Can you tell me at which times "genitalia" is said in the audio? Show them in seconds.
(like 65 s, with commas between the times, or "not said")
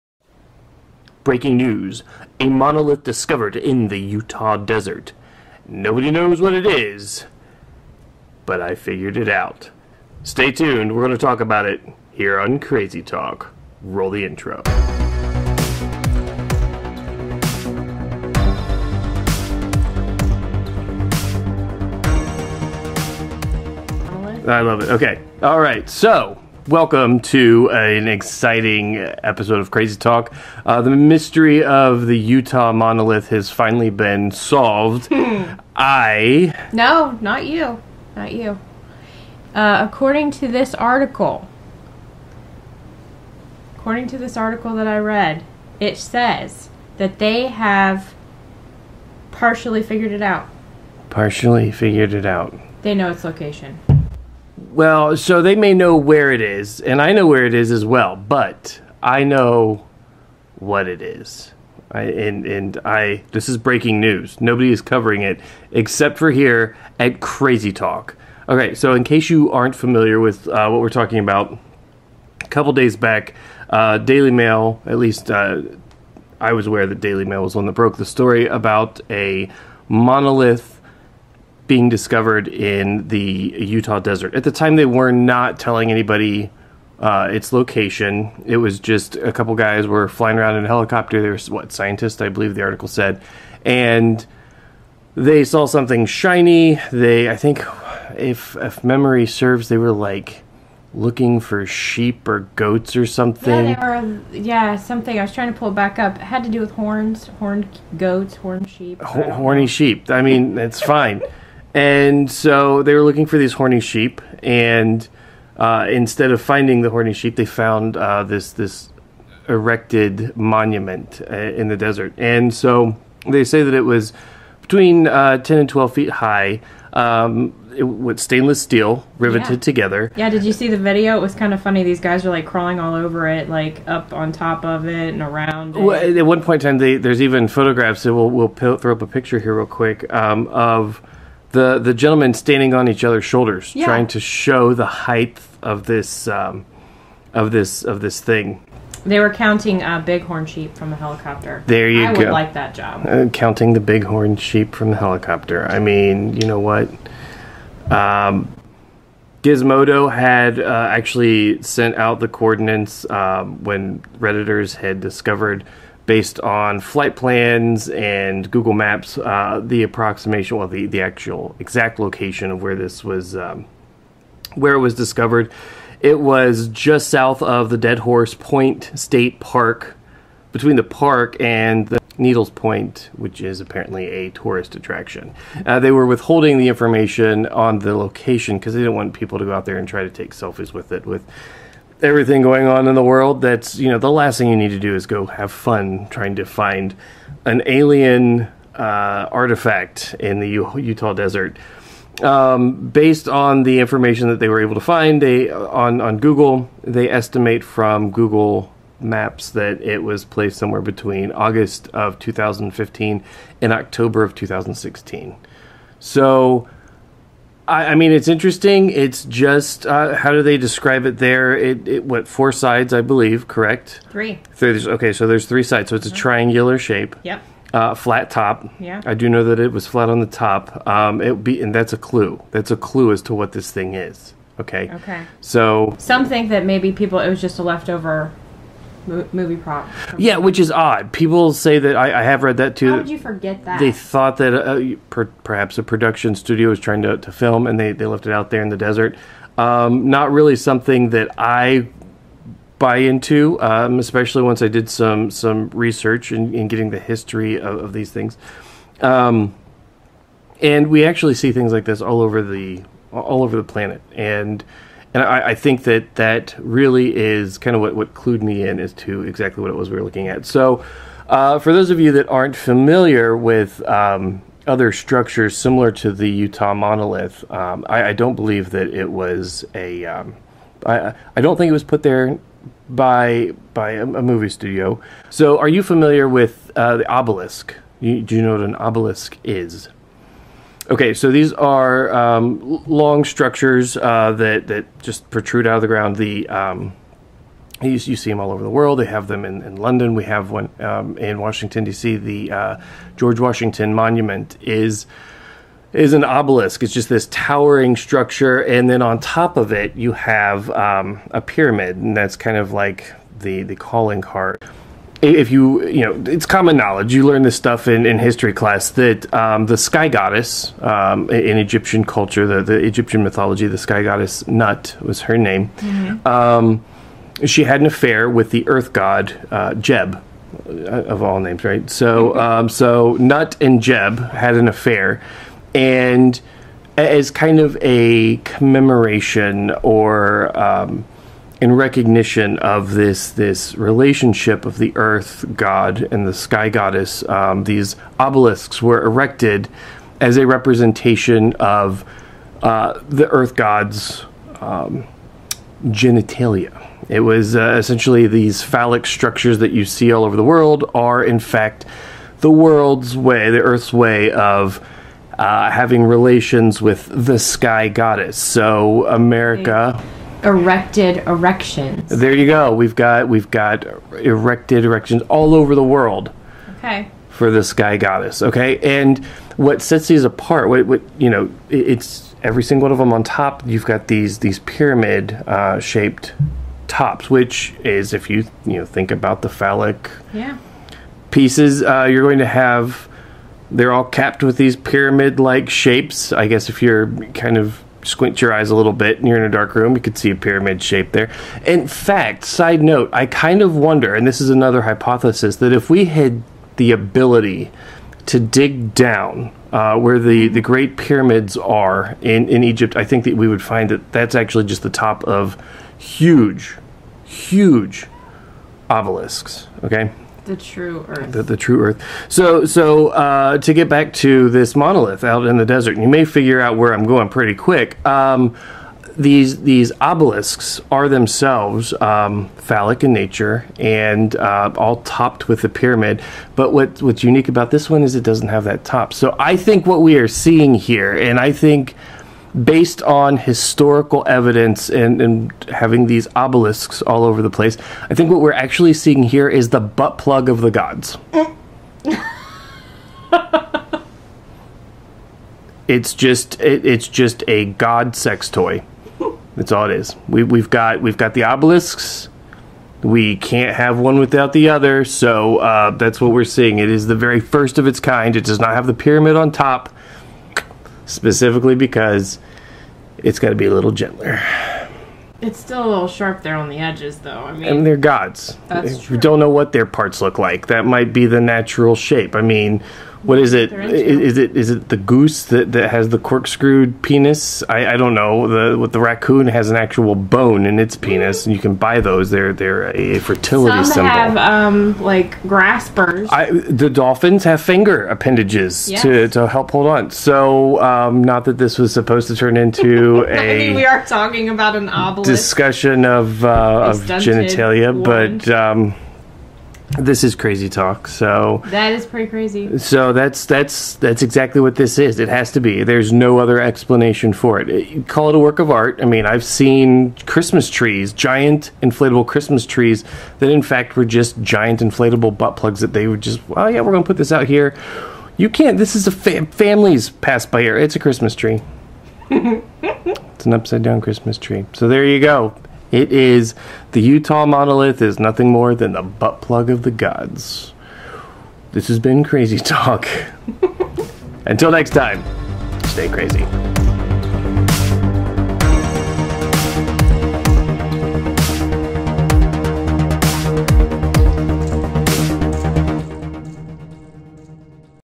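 355 s, 507 s.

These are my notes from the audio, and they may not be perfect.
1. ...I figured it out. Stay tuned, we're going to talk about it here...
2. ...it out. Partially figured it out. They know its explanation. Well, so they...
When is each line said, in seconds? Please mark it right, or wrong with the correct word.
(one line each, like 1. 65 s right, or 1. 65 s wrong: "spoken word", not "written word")
1. 8 s right
2. 50 s wrong: "location", not "explanation".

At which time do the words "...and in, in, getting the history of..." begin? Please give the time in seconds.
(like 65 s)
256 s.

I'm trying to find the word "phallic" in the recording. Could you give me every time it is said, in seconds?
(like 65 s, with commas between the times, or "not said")
358 s, 389 s, 432 s.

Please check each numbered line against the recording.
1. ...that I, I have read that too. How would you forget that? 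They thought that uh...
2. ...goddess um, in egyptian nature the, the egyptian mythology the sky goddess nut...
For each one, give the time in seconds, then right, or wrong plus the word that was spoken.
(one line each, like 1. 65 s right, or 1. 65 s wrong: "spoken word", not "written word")
1. 241 s right
2. 320 s wrong: "culture", not "nature".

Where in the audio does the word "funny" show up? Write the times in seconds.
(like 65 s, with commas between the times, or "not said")
131 s.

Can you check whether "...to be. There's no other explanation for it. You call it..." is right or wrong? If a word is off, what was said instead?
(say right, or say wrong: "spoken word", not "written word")
right.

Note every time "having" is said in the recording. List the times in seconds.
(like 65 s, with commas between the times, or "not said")
365 s, 445 s.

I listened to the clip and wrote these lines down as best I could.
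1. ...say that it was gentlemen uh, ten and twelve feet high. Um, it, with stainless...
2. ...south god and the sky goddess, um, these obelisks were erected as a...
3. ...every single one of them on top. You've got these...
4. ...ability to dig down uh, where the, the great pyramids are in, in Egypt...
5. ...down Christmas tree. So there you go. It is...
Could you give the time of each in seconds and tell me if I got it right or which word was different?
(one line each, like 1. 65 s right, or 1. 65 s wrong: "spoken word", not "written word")
1. 123 s wrong: "between", not "gentlemen"
2. 344 s wrong: "earth", not "south"
3. 382 s right
4. 406 s right
5. 533 s right.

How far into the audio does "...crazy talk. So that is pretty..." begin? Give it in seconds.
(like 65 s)
510 s.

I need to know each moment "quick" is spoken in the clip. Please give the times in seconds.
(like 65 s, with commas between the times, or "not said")
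139 s, 427 s.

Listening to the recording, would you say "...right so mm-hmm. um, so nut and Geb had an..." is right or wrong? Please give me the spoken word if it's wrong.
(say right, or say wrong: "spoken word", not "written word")
right.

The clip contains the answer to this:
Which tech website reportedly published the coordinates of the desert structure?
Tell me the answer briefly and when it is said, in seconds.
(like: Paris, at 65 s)
Gizmodo, at 159 s.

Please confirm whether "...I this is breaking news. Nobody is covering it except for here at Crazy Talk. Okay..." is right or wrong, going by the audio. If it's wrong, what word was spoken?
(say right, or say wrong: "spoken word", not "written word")
right.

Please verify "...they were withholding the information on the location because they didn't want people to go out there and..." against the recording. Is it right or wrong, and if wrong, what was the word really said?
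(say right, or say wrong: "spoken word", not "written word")
right.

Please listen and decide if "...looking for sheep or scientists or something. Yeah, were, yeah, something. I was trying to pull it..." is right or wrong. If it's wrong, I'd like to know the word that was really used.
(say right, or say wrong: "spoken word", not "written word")
wrong: "goats", not "scientists".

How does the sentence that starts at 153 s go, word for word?
Uh, counting the bighorn sheep from the helicopter.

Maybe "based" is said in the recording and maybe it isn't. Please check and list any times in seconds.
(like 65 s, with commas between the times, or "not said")
166 s, 202 s, 442 s.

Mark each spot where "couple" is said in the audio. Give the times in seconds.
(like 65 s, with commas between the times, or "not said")
72 s, 89 s.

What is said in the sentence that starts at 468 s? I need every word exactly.
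It does not have the pyramid on top specifically because it's got to be a little gentler.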